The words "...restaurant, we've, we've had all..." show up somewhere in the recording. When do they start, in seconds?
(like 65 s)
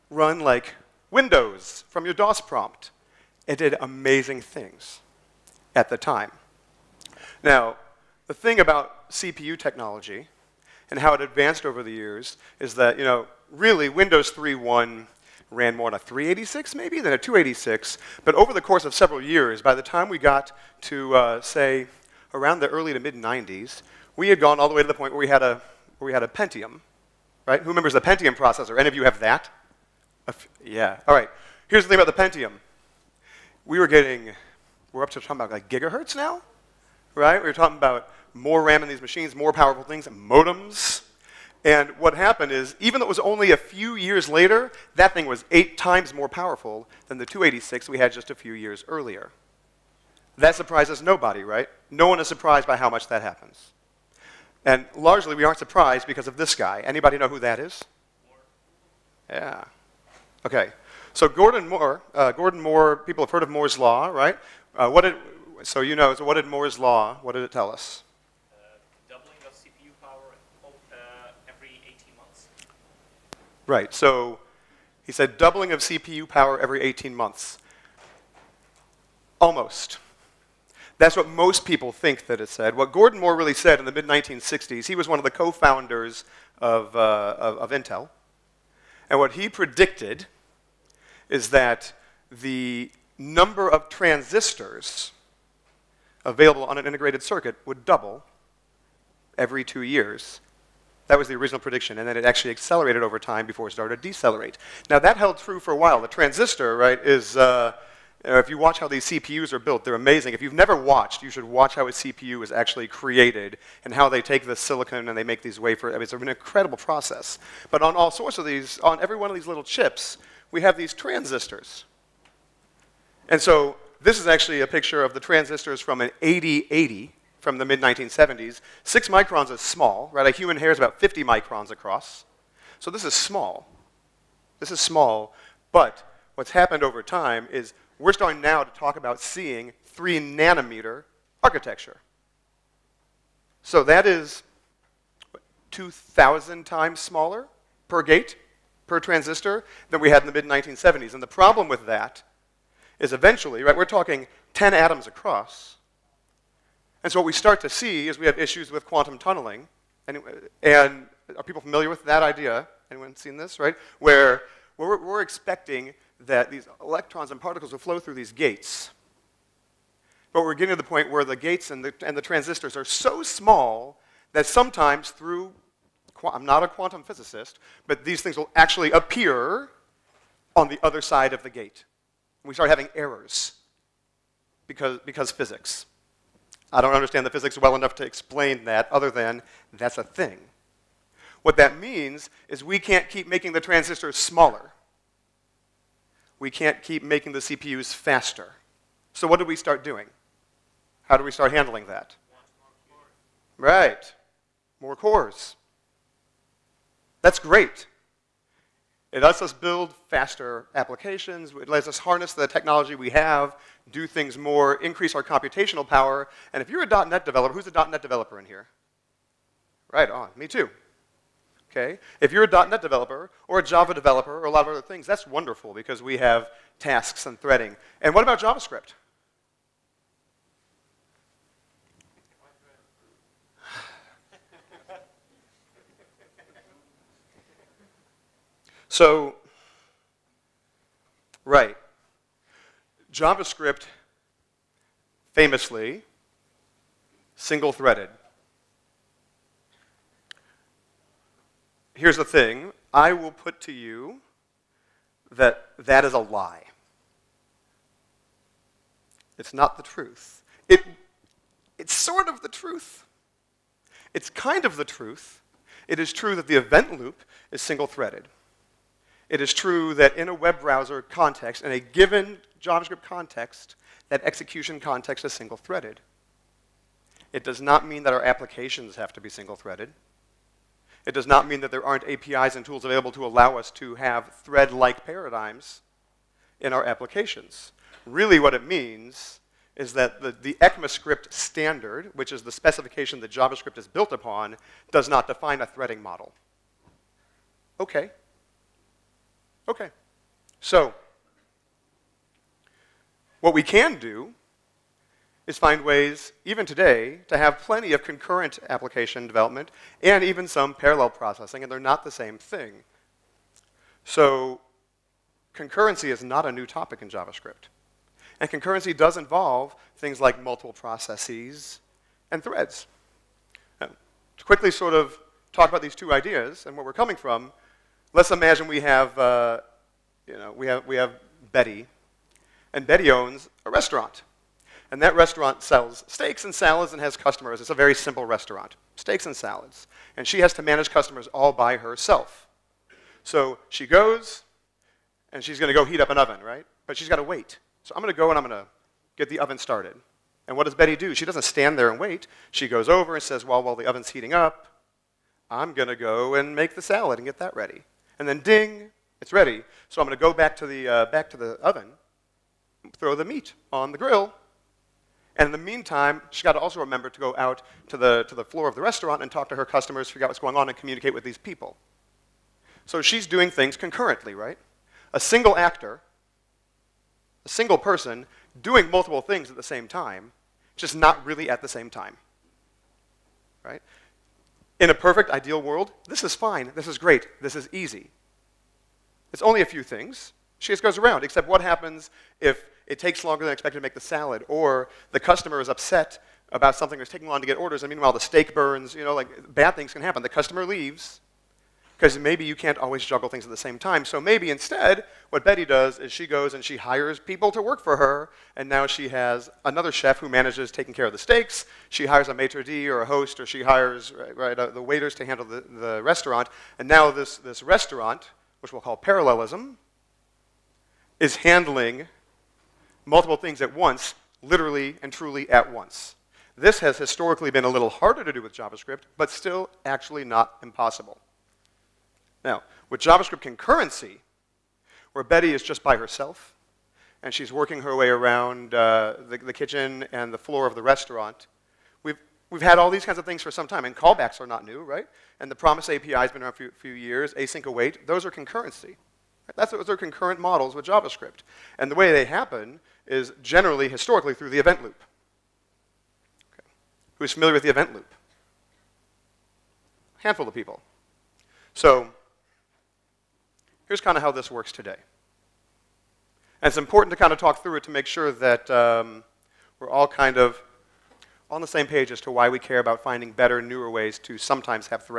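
440 s.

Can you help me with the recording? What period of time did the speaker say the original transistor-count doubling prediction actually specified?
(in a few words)
every 2 years.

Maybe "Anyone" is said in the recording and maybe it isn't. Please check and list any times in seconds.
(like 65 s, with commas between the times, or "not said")
162 s.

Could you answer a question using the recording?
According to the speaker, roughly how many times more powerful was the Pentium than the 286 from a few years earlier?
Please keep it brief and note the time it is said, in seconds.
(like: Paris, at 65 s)
8 times, at 45 s.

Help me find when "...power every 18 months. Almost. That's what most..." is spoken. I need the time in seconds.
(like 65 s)
76 s.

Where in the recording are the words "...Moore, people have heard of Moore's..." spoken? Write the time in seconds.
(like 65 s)
62 s.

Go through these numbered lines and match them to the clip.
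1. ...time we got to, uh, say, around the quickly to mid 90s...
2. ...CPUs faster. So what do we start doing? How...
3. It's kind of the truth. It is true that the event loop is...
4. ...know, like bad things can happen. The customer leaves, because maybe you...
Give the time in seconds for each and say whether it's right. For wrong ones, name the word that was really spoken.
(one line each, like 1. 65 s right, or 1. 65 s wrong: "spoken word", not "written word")
1. 19 s wrong: "early", not "quickly"
2. 197 s right
3. 264 s right
4. 399 s right.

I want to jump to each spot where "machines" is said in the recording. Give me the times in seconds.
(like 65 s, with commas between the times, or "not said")
39 s.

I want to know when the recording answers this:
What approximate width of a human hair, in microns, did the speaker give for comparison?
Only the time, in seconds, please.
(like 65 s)
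130 s.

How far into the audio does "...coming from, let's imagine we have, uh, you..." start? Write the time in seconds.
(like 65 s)
326 s.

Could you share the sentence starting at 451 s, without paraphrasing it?
And the way they happen is generally, historically, through the event loop.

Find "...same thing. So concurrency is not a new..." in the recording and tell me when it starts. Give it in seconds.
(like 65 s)
312 s.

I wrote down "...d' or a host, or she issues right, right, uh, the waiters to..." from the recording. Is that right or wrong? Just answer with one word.
wrong.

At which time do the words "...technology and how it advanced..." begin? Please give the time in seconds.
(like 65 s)
9 s.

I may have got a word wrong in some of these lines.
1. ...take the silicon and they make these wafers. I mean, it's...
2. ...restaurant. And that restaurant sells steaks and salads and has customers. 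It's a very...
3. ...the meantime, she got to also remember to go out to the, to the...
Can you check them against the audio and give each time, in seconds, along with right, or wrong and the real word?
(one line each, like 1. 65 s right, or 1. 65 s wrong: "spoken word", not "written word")
1. 114 s right
2. 333 s right
3. 365 s right.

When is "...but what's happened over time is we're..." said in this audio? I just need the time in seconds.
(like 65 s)
135 s.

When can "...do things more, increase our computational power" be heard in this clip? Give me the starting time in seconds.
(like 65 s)
213 s.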